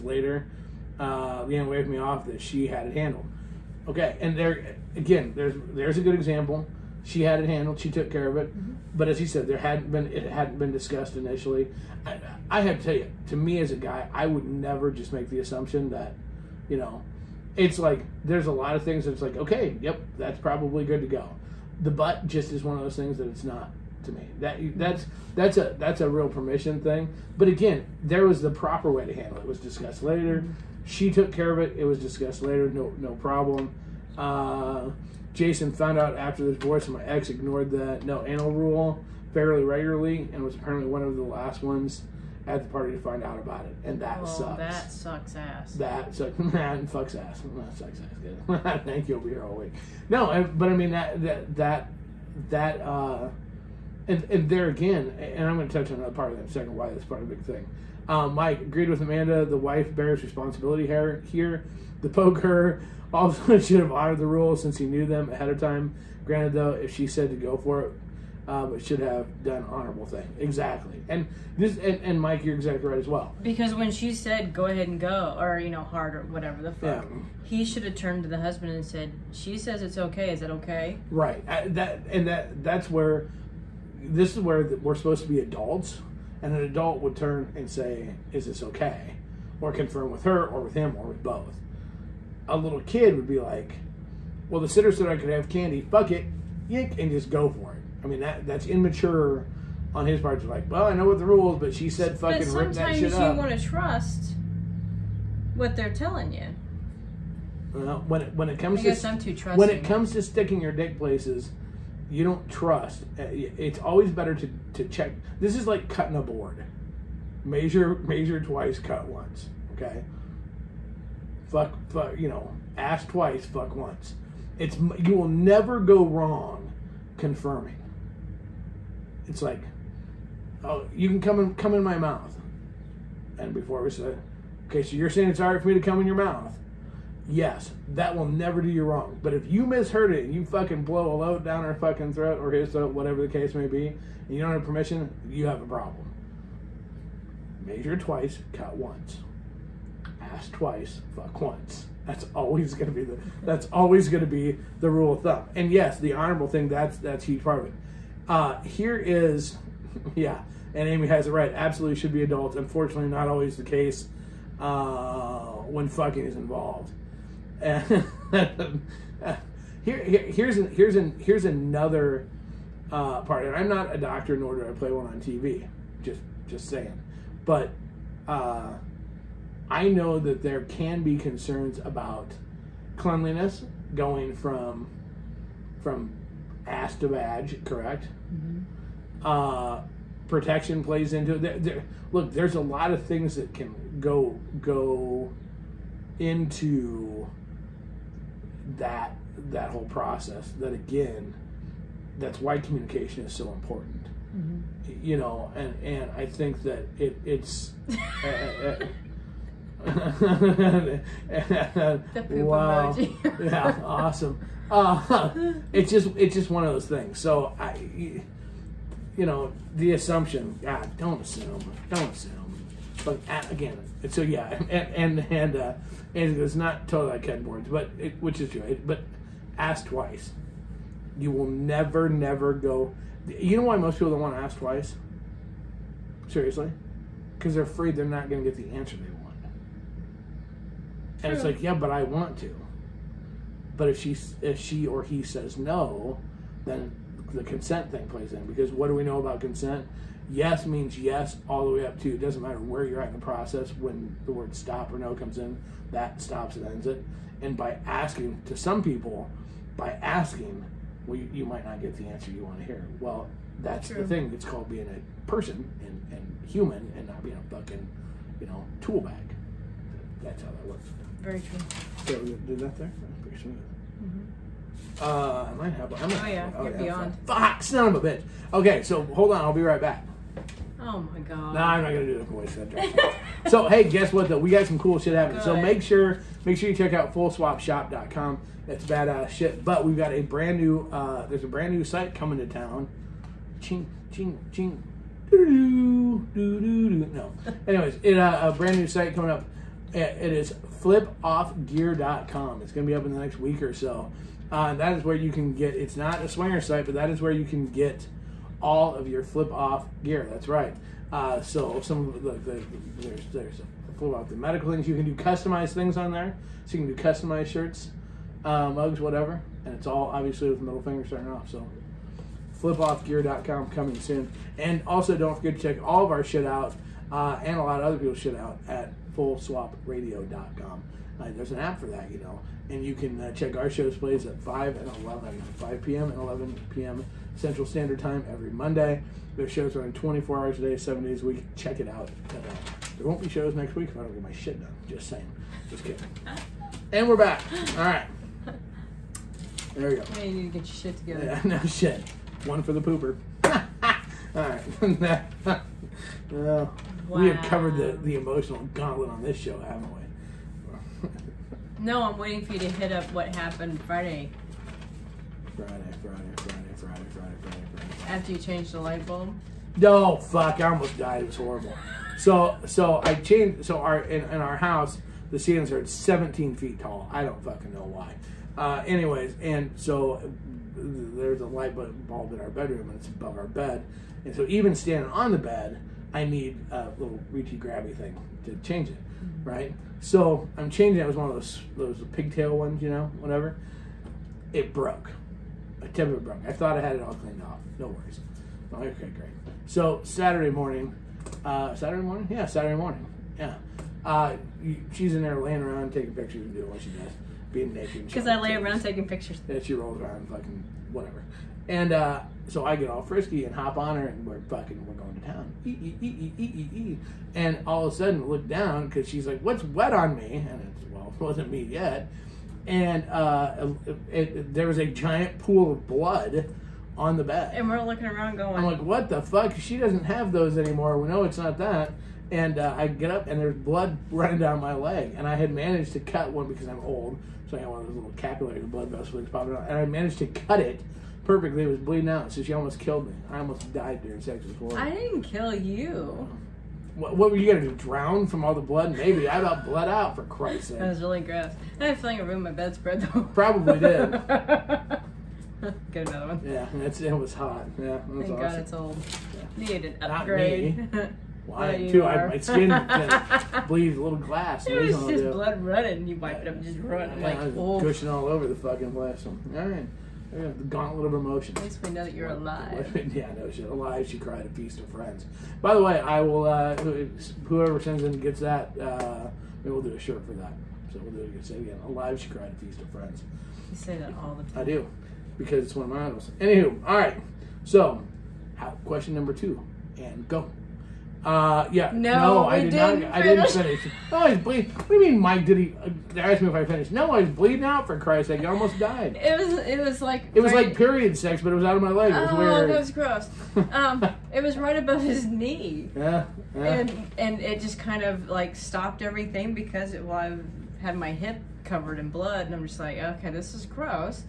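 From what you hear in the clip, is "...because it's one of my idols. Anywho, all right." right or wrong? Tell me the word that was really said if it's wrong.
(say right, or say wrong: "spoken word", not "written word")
right.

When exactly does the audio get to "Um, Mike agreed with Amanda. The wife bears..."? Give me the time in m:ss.
0:58.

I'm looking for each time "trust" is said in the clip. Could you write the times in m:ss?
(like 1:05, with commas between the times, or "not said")
1:43, 1:52.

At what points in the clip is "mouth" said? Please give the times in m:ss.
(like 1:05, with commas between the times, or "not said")
2:11, 2:16.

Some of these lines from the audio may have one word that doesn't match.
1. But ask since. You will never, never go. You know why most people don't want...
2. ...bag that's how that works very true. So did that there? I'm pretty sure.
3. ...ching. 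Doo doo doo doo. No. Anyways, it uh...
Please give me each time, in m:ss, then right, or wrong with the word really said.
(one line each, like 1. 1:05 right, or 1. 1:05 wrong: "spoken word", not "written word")
1. 3:48 wrong: "twice", not "since"
2. 4:29 right
3. 4:54 right.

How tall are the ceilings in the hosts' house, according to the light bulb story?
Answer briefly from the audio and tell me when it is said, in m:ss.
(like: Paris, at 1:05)
17 feet, at 6:15.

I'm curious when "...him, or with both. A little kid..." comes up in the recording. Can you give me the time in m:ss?
1:30.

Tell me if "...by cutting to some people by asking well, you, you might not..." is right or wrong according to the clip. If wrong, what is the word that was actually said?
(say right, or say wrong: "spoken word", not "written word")
wrong: "asking", not "cutting".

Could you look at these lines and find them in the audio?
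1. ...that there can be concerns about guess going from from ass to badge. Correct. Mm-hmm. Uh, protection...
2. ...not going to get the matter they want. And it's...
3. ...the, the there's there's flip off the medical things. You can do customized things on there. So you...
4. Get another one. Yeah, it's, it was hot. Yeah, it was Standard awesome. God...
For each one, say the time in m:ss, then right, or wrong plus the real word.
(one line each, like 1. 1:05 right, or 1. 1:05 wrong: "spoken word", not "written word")
1. 3:00 wrong: "cleanliness", not "guess"
2. 3:58 wrong: "answer", not "matter"
3. 5:12 right
4. 7:35 wrong: "Thank", not "Standard".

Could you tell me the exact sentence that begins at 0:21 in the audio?
The butt just is one of those things that it's not to me.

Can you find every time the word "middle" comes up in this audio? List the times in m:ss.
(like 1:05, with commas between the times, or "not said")
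5:20.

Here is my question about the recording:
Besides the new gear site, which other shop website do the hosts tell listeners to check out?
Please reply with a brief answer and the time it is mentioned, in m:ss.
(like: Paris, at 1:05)
fullswapshop.com, at 4:47.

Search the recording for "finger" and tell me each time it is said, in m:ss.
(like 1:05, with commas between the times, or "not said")
5:20.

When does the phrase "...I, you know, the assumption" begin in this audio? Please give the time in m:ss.
3:37.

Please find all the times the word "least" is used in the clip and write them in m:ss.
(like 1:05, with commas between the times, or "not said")
7:51.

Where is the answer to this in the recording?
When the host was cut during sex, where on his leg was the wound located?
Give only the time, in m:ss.
8:24.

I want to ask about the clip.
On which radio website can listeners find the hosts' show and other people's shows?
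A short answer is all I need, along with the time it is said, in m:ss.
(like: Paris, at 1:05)
fullswapradio.com, at 5:29.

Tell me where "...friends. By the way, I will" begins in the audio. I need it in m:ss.
7:54.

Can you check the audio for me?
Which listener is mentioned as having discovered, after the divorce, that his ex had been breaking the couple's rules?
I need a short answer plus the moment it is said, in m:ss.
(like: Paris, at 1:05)
Jason, at 0:35.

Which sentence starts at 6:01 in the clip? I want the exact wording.
no, I'm waiting for you to hit up what happened Friday.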